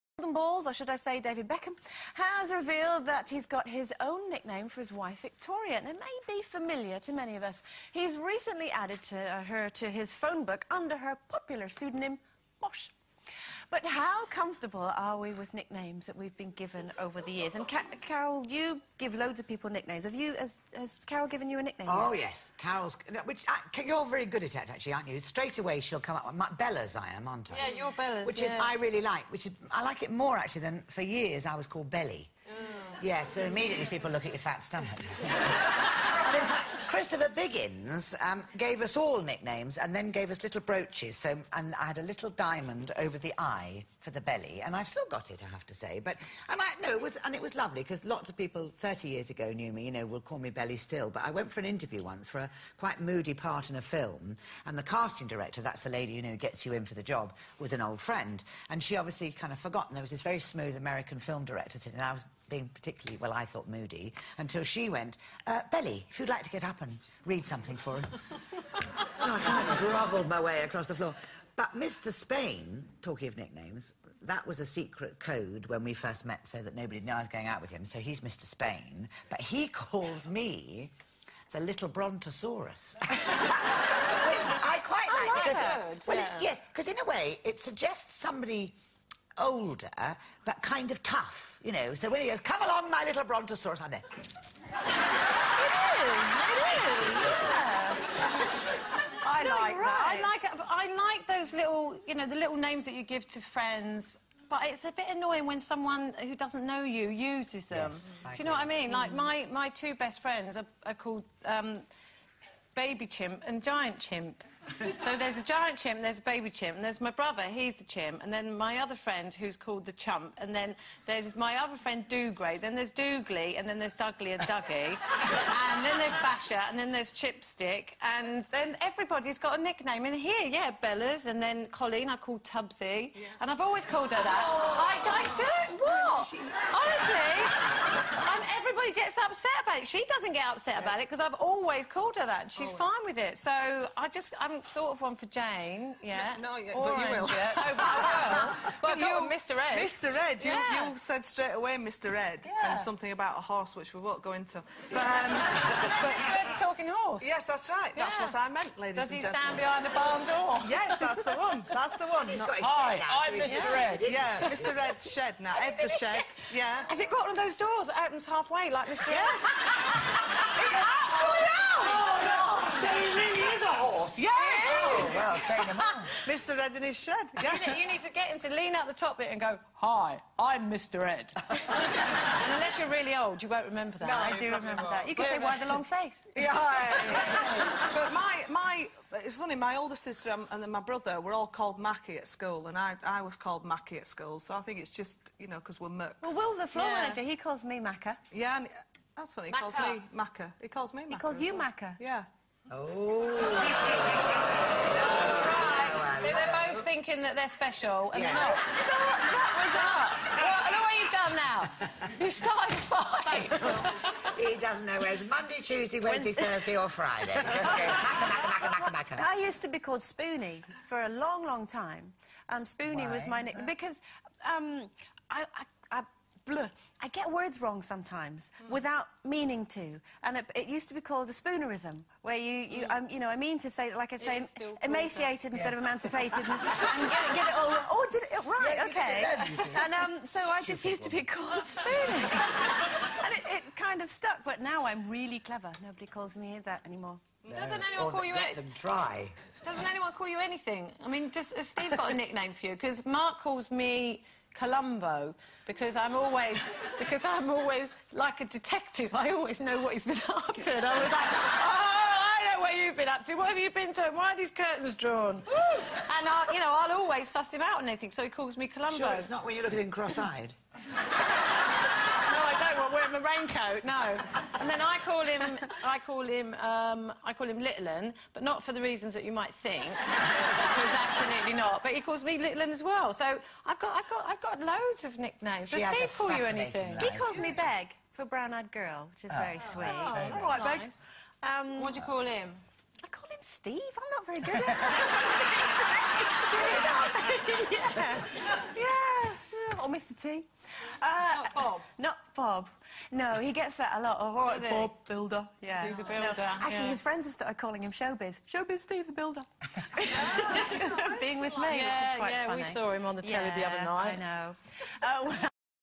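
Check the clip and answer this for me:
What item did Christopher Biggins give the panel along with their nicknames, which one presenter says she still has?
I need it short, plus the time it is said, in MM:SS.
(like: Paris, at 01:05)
Little brooches, at 00:40.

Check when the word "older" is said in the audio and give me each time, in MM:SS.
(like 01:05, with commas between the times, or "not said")
01:29, 03:09.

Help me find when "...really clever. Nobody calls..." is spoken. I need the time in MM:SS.
04:05.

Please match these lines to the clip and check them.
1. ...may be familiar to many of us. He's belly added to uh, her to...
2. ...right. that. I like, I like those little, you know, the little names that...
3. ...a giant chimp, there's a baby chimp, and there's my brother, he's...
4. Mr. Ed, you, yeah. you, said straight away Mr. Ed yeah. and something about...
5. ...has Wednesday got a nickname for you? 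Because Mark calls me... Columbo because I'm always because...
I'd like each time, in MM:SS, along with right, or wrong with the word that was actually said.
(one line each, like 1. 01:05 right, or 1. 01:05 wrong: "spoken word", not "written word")
1. 00:05 wrong: "recently", not "belly"
2. 01:39 right
3. 01:55 right
4. 02:29 right
5. 04:11 wrong: "Steve", not "Wednesday".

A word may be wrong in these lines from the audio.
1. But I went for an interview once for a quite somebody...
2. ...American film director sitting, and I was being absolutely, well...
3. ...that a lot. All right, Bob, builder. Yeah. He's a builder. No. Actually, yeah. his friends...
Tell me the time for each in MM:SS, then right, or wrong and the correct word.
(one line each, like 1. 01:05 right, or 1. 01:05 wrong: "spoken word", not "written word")
1. 00:51 wrong: "moody", not "somebody"
2. 01:00 wrong: "particularly", not "absolutely"
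3. 05:03 right.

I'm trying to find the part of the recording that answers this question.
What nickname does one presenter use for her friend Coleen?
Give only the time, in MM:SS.
02:12.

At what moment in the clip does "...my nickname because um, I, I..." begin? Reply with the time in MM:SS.
03:43.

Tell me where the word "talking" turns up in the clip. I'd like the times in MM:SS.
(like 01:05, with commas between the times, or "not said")
01:13, 02:36.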